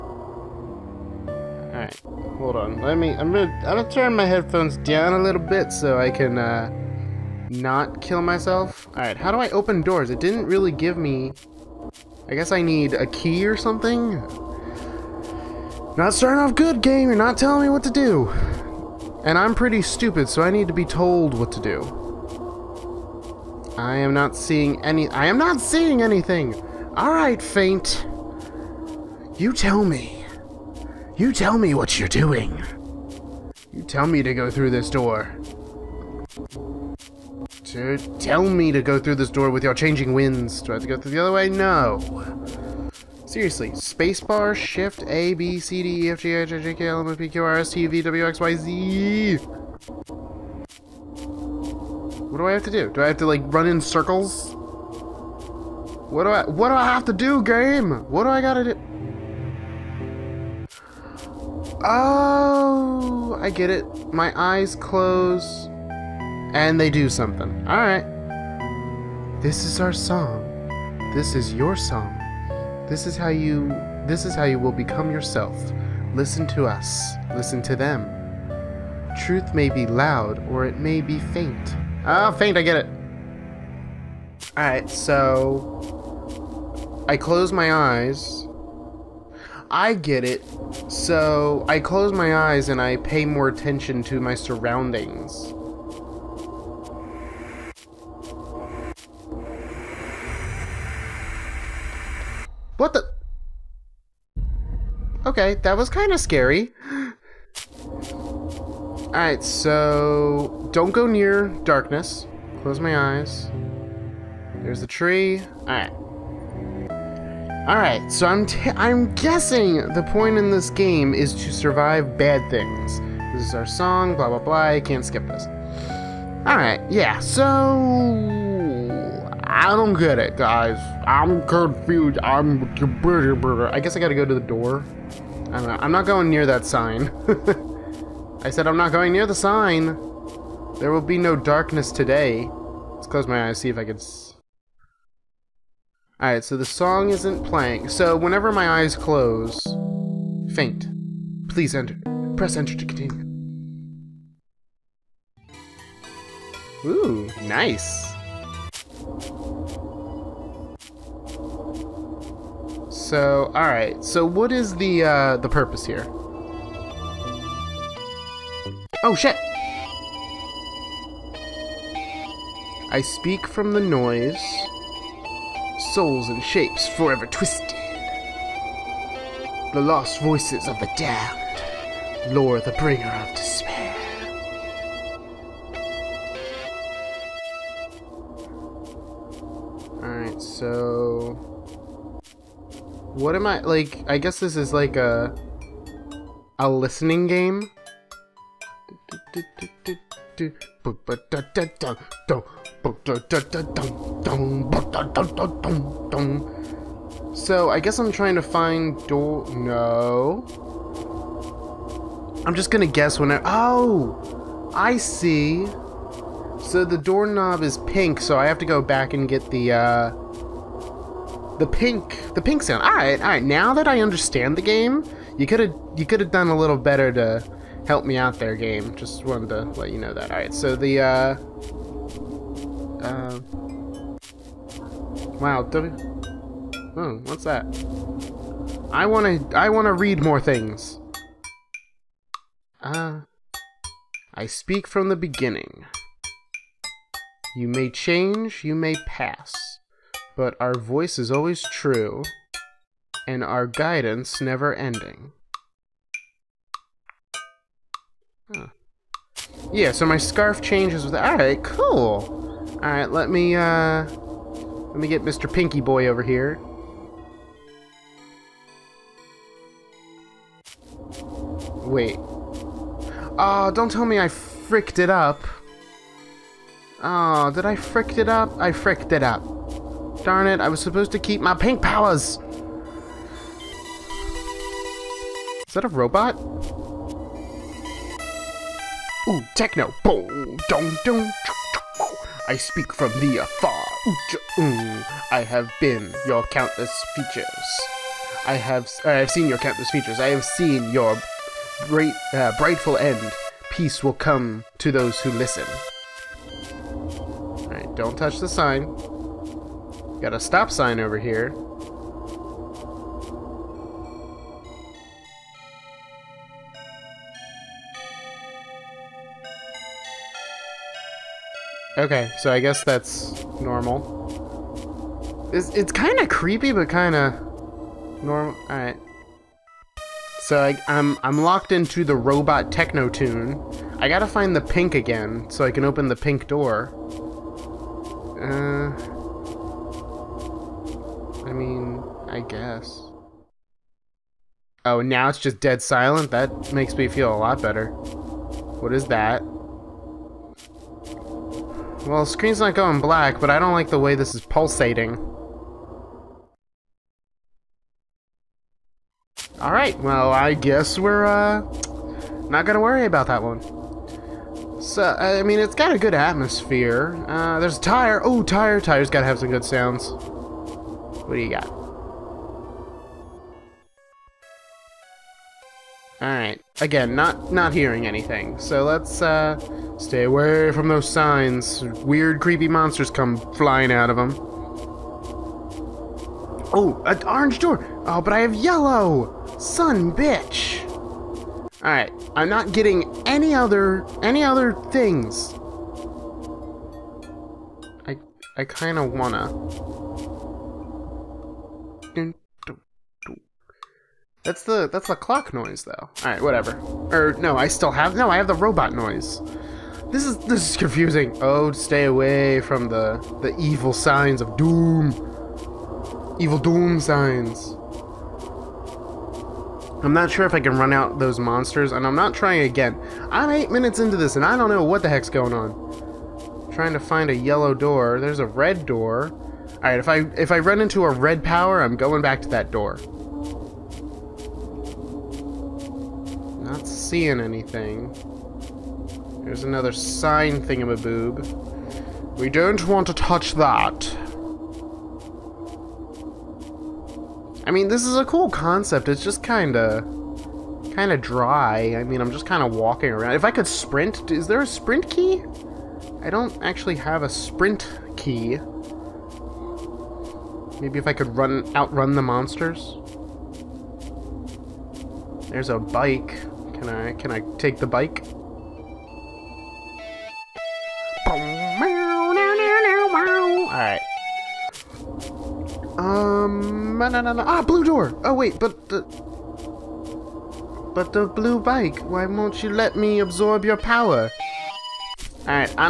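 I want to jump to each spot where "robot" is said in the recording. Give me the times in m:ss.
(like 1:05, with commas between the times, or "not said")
4:45, 5:32, 6:48.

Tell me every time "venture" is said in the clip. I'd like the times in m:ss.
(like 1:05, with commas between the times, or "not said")
not said.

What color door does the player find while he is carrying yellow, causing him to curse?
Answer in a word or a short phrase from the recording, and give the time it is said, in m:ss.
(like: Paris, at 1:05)
Orange, at 6:27.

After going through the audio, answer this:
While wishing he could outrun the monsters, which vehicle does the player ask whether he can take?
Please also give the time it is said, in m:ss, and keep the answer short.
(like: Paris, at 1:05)
A bike, at 7:45.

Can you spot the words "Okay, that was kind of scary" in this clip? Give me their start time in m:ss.
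1:45.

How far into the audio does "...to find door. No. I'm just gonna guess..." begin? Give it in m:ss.
3:28.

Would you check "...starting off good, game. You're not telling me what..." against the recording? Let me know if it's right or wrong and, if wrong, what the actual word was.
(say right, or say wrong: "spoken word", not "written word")
right.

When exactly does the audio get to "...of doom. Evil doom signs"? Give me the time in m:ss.
6:54.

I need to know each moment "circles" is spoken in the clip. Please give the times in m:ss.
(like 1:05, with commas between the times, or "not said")
0:53.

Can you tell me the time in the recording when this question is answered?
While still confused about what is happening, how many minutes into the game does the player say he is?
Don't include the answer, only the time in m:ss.
7:03.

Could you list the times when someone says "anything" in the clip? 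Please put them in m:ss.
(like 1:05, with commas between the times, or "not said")
0:26, 6:18, 7:17.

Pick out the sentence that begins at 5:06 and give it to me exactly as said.
All right, don't touch the sign.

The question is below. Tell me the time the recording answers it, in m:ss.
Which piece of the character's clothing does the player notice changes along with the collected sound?
4:20.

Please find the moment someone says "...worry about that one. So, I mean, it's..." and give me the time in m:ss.
6:02.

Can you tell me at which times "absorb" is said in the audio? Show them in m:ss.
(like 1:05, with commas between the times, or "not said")
8:03.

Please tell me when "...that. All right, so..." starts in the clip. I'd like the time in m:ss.
3:50.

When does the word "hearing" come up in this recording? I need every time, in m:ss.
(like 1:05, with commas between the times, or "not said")
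6:17.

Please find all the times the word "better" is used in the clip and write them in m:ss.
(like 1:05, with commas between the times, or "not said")
3:46, 5:47.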